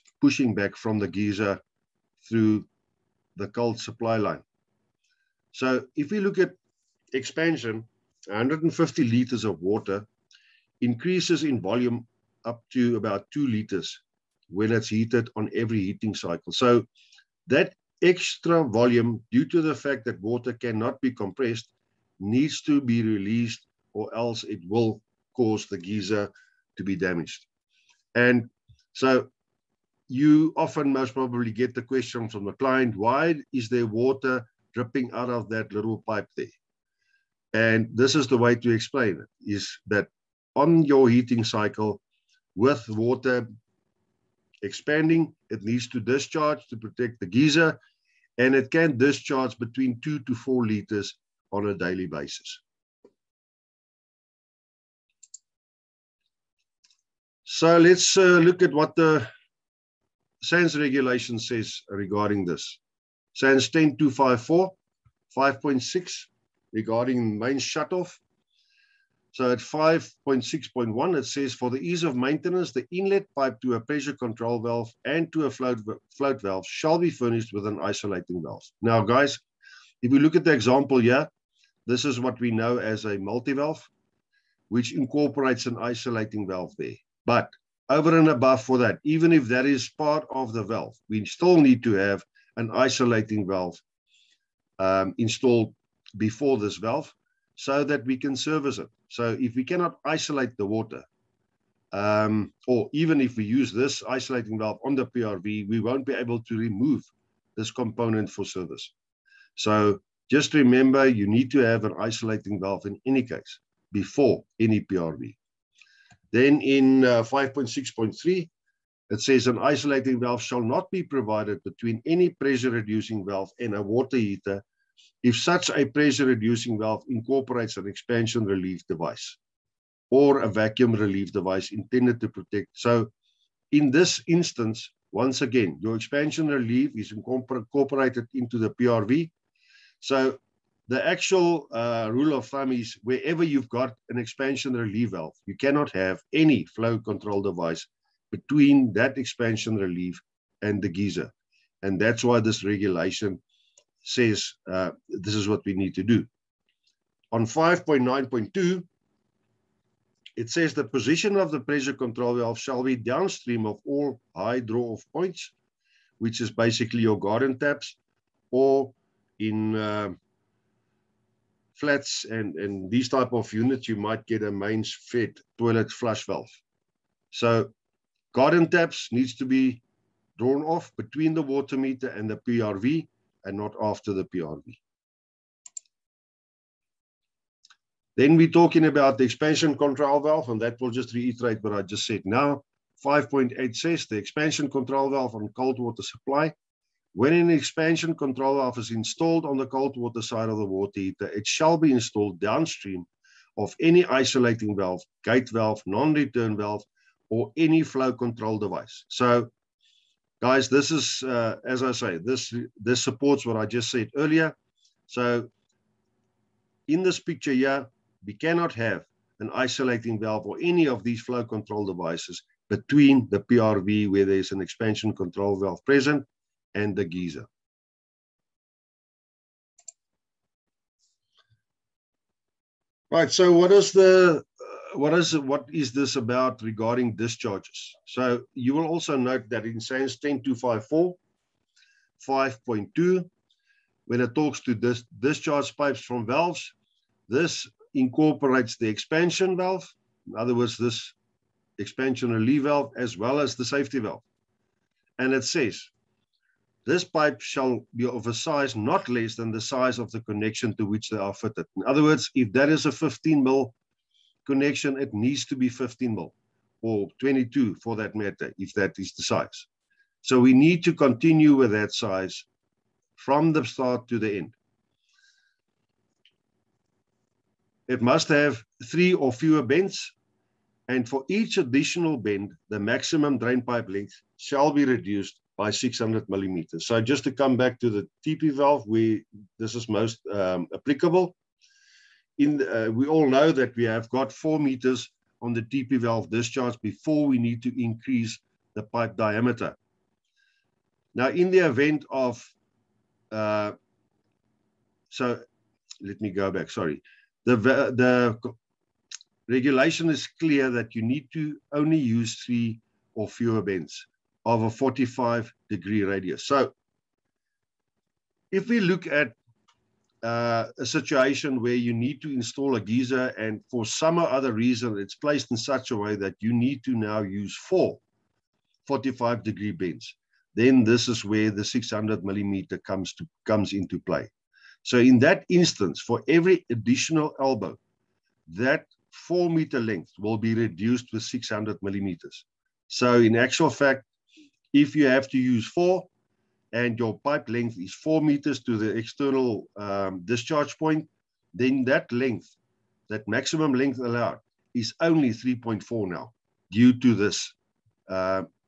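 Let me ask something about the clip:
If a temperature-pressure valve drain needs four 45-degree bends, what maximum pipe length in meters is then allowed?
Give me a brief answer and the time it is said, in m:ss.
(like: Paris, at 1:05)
3.4 meters, at 5:55.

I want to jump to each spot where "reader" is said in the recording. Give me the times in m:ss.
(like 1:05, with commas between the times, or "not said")
not said.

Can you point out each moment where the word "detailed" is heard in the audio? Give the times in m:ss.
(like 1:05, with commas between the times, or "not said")
not said.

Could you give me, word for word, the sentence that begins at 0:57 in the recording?
So let's uh, look at what the SANS regulation says regarding this.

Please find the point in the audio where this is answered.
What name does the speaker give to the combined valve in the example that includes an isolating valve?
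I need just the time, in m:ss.
1:23.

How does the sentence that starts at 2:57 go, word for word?
So Garden taps needs to be drawn off between the water meter and the PRV and not after the PRV.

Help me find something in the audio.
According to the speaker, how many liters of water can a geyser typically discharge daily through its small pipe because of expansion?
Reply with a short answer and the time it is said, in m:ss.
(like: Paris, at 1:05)
2 to 4 liters, at 0:50.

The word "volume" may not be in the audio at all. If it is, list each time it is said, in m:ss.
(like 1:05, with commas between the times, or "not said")
0:11, 0:18.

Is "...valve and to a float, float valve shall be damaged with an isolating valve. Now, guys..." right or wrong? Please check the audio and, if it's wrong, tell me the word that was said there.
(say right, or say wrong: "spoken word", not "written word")
wrong: "furnished", not "damaged".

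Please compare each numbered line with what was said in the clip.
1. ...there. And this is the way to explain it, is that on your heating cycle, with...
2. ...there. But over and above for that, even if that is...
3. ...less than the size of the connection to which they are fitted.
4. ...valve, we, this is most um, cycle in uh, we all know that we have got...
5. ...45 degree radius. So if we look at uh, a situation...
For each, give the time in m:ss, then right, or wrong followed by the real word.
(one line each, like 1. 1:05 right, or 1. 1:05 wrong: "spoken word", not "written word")
1. 0:36 right
2. 1:26 right
3. 4:19 right
4. 4:48 wrong: "applicable", not "cycle"
5. 5:14 right.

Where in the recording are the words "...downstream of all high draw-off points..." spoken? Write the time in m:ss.
2:42.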